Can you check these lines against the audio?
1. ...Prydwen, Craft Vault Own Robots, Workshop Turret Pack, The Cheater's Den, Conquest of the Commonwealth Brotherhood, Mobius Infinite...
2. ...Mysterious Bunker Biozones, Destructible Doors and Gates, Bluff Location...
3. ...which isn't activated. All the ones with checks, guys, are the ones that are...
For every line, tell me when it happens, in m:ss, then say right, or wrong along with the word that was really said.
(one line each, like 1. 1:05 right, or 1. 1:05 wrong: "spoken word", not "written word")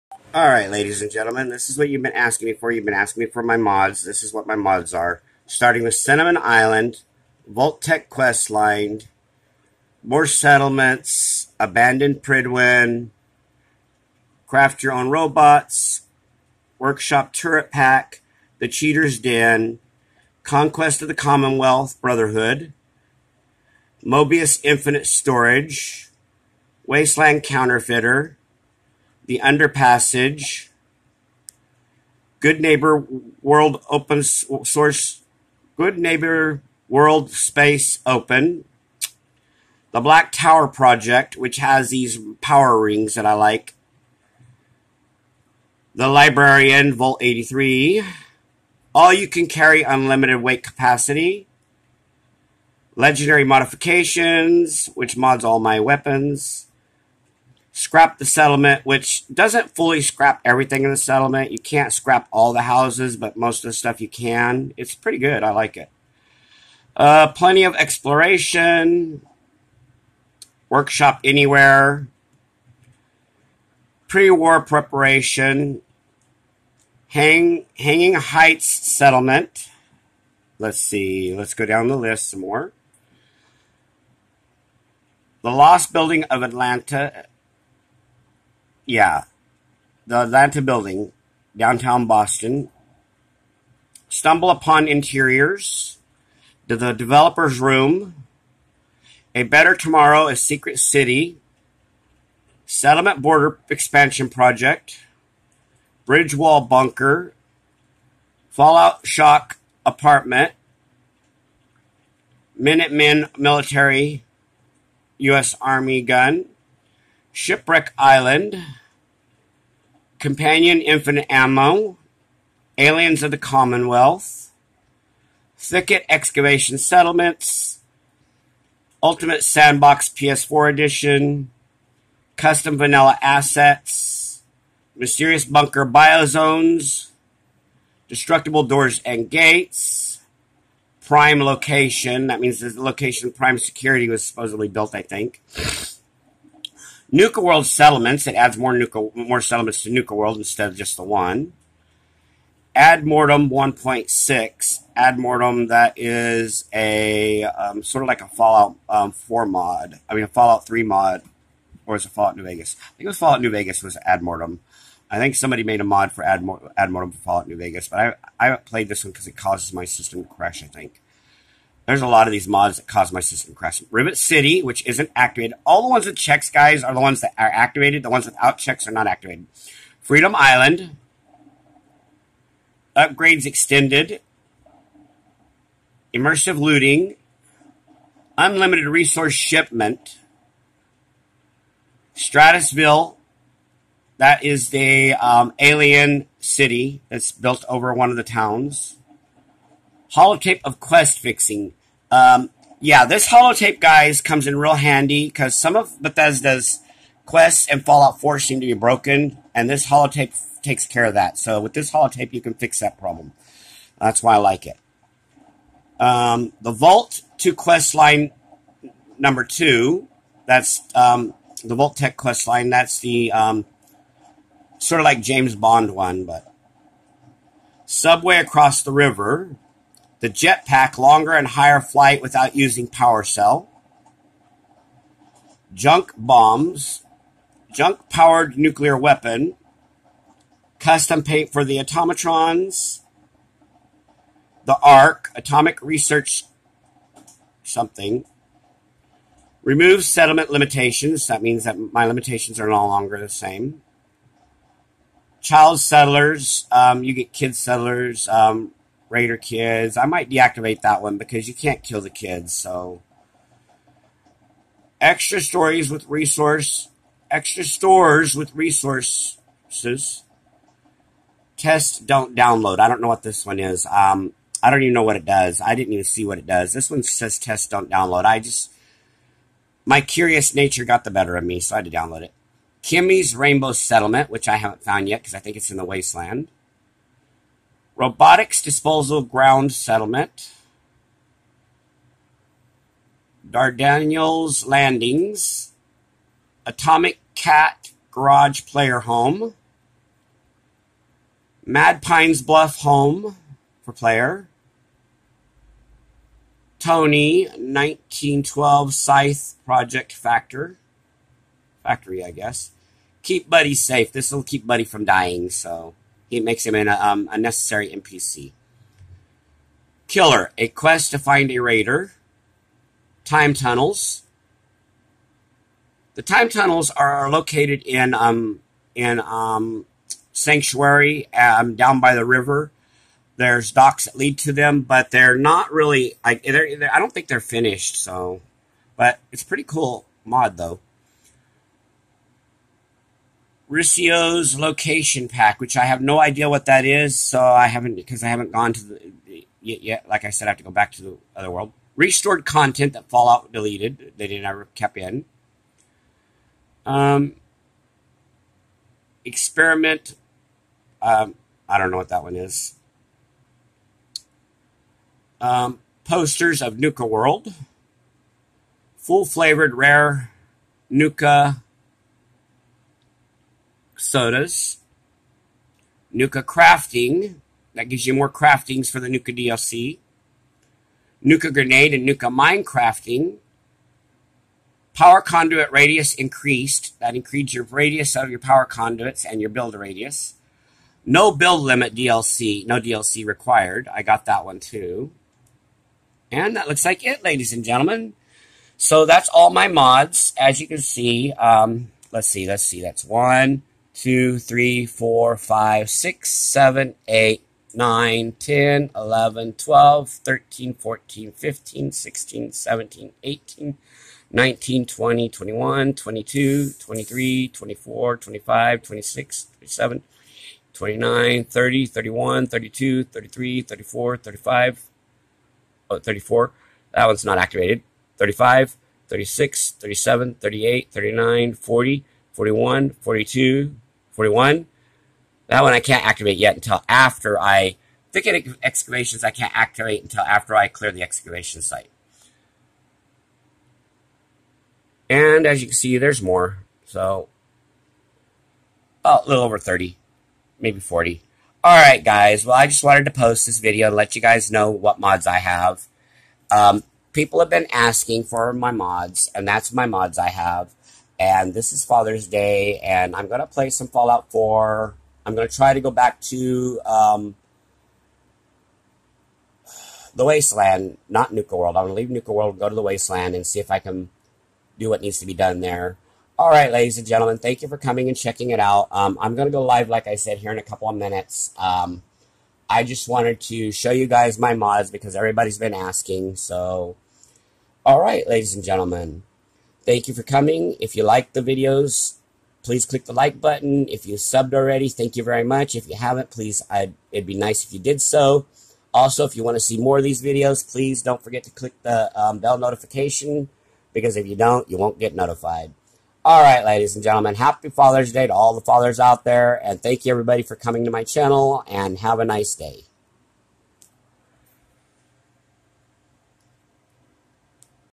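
1. 0:12 wrong: "Your", not "Vault"
2. 2:14 wrong: "Prime", not "Bluff"
3. 2:54 right.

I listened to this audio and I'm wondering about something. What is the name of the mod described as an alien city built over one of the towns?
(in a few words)
Stratusville.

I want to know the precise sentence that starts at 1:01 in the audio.
You can't scrap all the houses, but most of the stuff you can.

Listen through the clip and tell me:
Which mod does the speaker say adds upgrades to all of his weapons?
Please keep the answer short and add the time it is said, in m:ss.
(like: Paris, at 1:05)
Legendary Modifications, at 0:52.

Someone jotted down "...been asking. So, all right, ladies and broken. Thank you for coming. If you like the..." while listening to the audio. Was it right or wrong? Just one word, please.
wrong.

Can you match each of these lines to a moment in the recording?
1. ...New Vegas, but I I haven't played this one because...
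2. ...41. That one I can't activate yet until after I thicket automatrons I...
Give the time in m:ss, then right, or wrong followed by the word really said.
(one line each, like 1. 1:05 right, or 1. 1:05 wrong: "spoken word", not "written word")
1. 2:47 right
2. 7:14 wrong: "excavations", not "automatrons".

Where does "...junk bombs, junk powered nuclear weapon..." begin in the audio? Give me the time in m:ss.
3:55.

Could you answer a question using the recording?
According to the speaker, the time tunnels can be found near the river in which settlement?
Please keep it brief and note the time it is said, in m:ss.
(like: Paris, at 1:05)
Sanctuary, at 5:30.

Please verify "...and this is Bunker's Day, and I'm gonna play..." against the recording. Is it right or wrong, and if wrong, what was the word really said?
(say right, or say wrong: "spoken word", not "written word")
wrong: "Father", not "Bunker".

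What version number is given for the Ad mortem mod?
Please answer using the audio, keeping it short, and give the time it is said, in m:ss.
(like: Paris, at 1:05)
1.6, at 2:33.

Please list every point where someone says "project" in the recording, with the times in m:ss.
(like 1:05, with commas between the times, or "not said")
0:40, 1:44, 5:09.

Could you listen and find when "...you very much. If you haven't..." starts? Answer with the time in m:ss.
8:15.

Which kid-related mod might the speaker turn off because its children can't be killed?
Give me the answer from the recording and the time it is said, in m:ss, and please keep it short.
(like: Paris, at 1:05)
Raider Kids, at 4:19.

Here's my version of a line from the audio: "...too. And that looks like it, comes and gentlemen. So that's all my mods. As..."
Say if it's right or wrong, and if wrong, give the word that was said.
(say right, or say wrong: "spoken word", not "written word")
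wrong: "ladies", not "comes".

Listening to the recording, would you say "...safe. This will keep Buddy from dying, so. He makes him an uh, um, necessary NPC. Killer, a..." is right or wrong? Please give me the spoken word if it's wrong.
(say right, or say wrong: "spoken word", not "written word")
right.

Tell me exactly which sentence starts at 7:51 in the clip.
I'm gonna leave Nuka World, go to the Wasteland, and see if I can do what needs to be done there.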